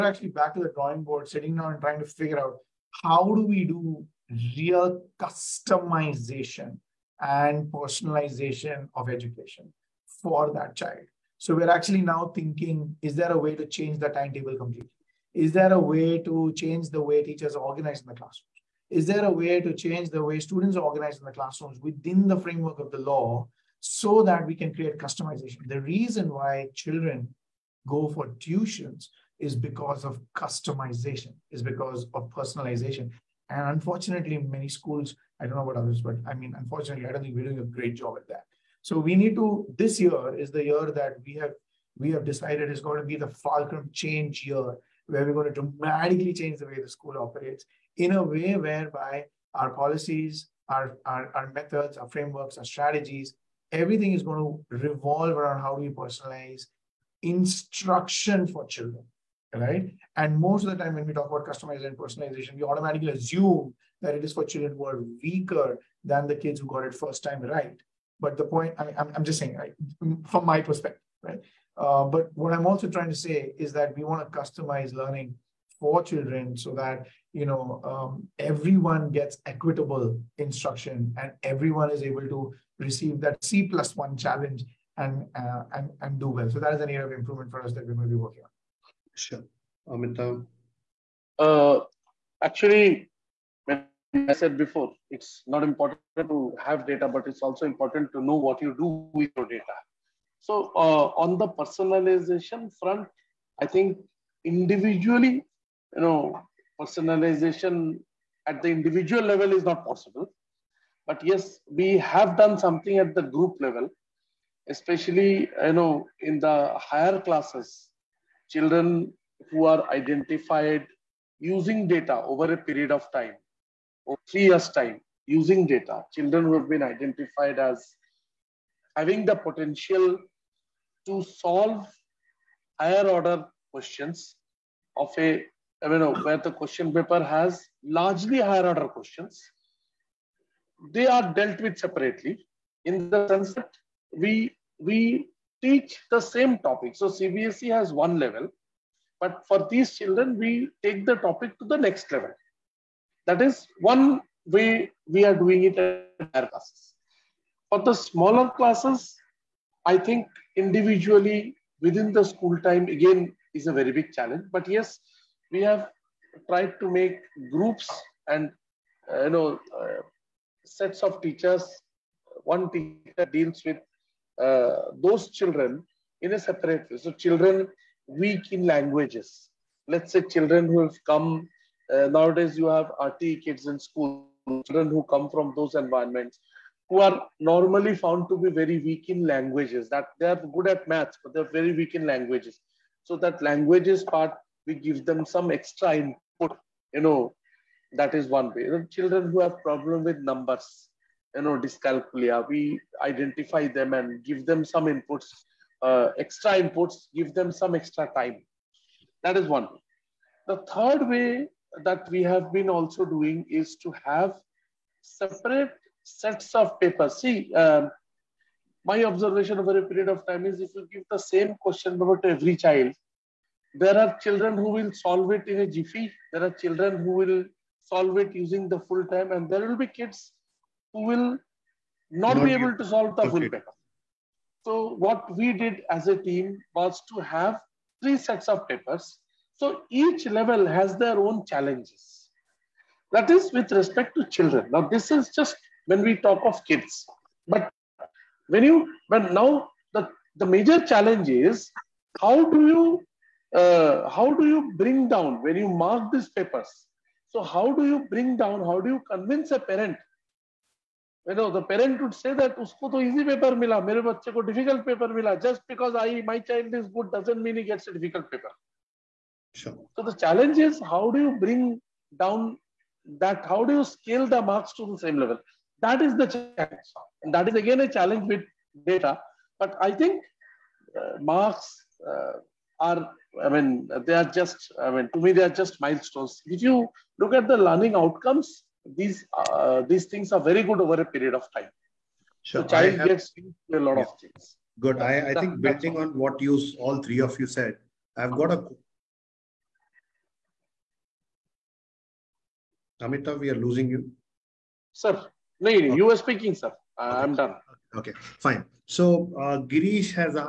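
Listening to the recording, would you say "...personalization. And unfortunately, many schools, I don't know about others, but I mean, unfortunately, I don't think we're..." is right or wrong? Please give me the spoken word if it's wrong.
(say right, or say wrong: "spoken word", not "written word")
right.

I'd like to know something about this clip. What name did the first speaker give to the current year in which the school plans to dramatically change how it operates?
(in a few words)
Falcon change year.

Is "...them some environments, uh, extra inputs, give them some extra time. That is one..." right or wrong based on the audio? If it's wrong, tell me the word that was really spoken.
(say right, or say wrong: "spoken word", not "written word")
wrong: "inputs", not "environments".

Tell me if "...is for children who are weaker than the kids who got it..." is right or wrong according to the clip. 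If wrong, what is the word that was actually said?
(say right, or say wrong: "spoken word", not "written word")
right.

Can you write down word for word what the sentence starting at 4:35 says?
That is the challenge, and that is again a challenge with data.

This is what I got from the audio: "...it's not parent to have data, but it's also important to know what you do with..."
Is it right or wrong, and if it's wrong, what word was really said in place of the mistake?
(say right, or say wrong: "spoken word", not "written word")
wrong: "important", not "parent".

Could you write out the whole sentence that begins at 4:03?
That is with respect to children.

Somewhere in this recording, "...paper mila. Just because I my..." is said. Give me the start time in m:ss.
4:24.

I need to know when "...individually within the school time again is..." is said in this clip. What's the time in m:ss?
2:40.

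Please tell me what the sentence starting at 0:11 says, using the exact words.
So we're actually now thinking, is there a way to change the timetable completely?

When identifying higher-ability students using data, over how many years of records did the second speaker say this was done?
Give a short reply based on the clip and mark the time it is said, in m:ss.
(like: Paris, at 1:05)
3 years, at 2:04.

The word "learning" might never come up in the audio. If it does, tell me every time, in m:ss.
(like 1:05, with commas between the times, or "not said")
1:14, 4:47.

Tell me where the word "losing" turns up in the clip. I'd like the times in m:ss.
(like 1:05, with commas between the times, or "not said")
5:03.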